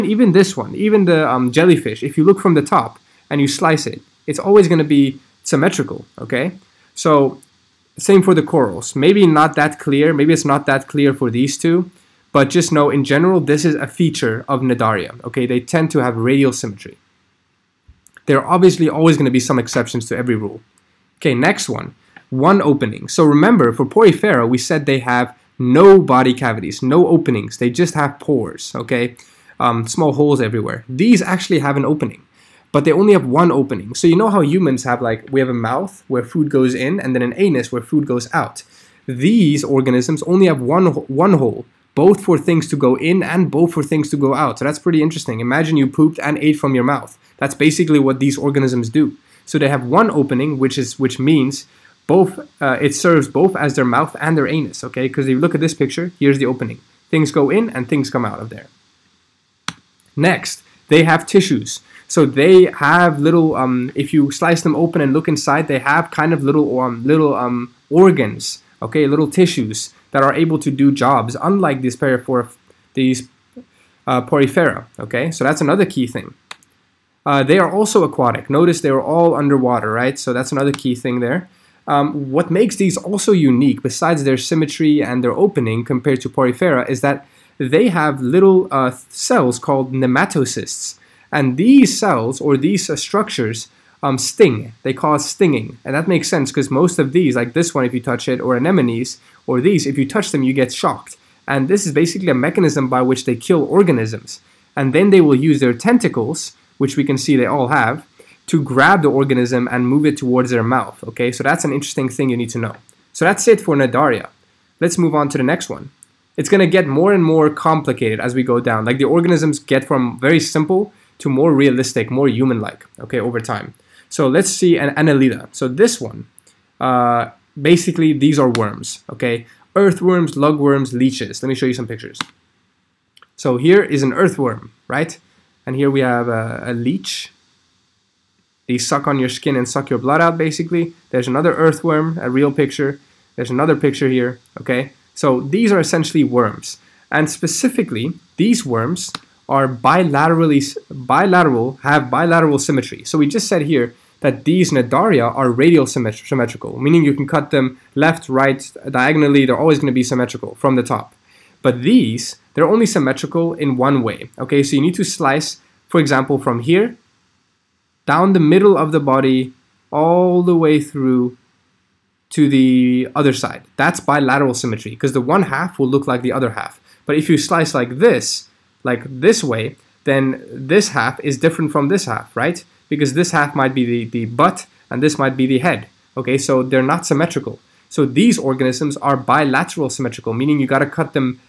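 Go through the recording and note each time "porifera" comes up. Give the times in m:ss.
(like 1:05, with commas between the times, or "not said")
0:23, 1:14, 1:26.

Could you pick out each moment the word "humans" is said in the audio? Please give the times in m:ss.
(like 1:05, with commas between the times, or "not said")
0:34, 2:02.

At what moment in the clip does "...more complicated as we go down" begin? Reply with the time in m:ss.
1:57.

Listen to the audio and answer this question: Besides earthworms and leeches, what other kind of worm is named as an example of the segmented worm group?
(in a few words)
Lugworms.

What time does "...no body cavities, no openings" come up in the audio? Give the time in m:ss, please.
0:25.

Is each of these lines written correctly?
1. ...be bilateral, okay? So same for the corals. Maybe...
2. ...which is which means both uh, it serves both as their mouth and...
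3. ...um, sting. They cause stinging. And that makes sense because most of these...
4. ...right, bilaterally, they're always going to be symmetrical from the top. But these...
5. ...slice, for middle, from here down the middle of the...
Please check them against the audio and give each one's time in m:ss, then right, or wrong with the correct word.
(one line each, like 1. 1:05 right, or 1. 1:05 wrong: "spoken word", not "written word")
1. 0:04 wrong: "symmetrical", not "bilateral"
2. 0:50 right
3. 1:34 right
4. 2:38 wrong: "diagonally", not "bilaterally"
5. 2:45 wrong: "example", not "middle".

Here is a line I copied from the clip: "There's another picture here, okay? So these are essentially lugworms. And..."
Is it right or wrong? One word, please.
wrong.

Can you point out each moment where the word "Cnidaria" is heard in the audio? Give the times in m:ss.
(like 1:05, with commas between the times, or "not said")
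0:14, 1:53, 2:34.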